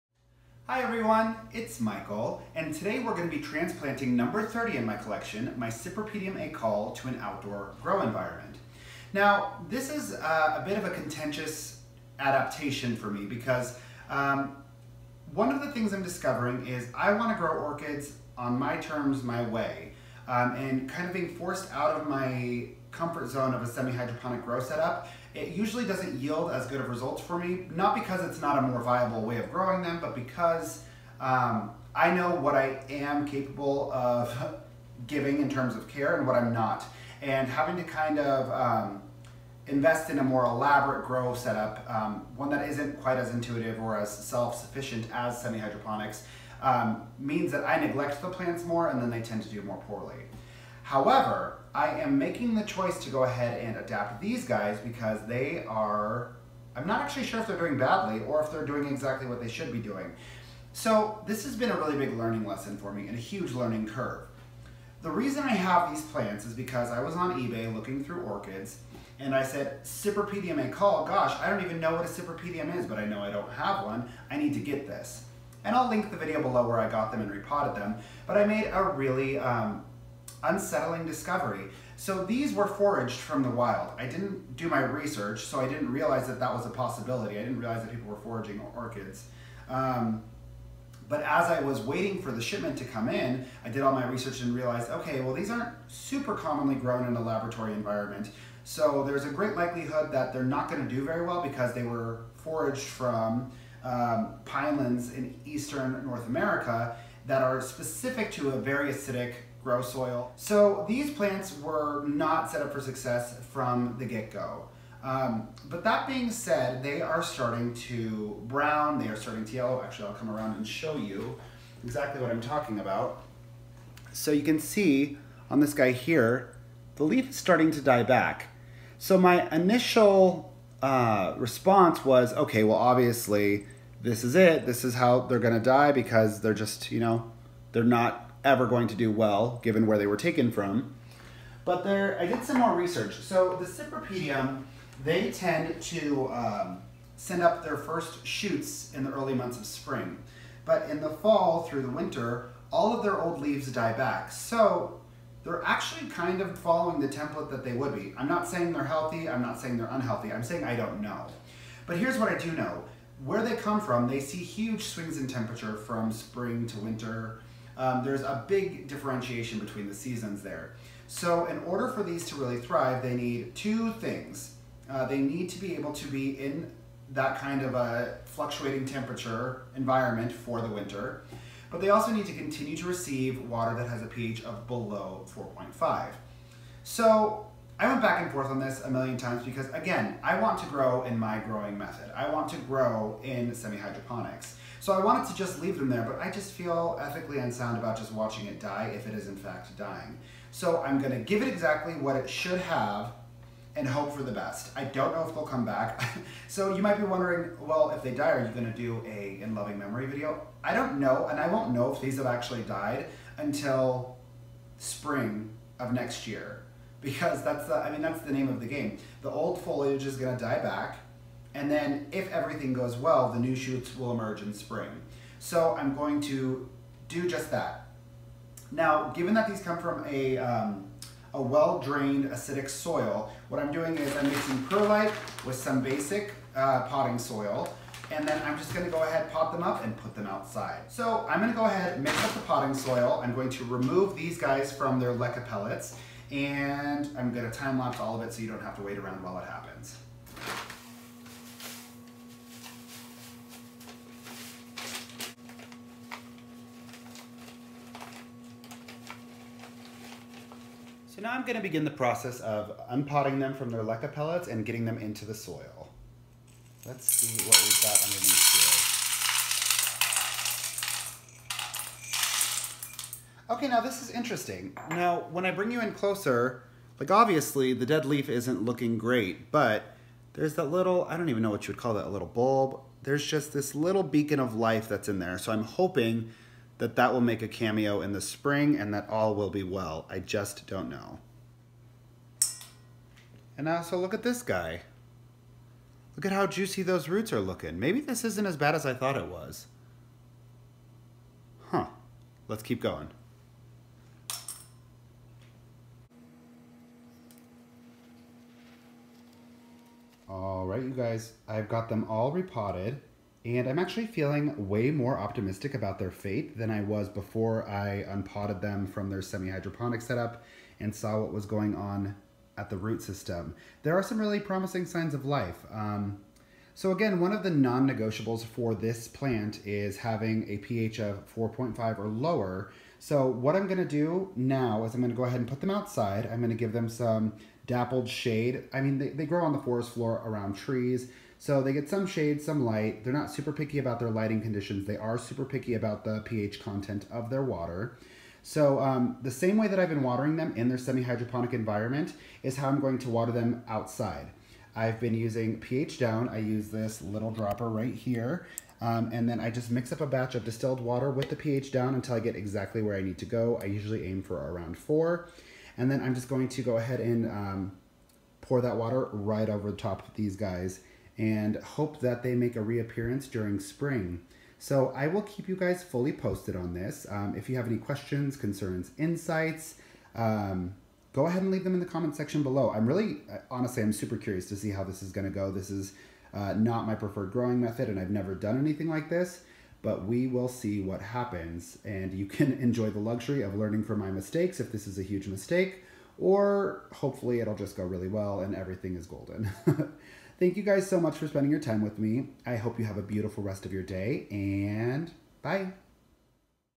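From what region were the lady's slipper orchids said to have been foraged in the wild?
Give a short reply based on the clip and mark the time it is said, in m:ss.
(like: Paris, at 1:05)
Eastern North America, at 1:45.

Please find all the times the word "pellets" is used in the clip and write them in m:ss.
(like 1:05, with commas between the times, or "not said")
4:05, 4:24.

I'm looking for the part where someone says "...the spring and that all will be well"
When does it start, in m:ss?
4:48.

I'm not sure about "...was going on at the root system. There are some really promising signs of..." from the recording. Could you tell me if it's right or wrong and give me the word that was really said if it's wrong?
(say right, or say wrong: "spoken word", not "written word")
right.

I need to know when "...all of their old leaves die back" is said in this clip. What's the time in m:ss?
2:32.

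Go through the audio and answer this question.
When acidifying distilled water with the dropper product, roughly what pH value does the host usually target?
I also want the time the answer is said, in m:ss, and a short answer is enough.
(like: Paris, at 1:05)
4, at 6:04.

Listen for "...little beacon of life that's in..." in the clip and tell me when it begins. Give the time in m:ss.
4:43.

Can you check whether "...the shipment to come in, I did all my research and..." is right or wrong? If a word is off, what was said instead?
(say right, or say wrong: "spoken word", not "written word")
right.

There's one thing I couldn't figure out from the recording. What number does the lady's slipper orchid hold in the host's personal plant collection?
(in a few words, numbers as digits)
30.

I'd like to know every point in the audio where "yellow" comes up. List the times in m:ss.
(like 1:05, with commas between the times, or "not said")
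1:59.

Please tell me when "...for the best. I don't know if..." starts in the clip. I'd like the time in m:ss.
3:24.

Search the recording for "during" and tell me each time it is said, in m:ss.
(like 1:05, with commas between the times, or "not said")
6:13.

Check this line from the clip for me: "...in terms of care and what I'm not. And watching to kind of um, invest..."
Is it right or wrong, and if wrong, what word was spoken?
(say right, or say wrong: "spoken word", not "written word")
wrong: "having", not "watching".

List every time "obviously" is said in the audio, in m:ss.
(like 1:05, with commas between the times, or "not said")
2:12, 4:37.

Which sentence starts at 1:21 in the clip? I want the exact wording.
So these were foraged from the wild.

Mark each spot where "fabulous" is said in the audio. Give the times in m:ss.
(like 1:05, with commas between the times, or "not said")
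not said.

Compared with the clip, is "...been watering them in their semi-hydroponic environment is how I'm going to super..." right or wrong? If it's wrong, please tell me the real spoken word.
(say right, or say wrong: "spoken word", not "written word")
wrong: "water", not "super".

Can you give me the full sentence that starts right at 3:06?
So I went back and forth on this a million times because, again, I want to grow in my growing method.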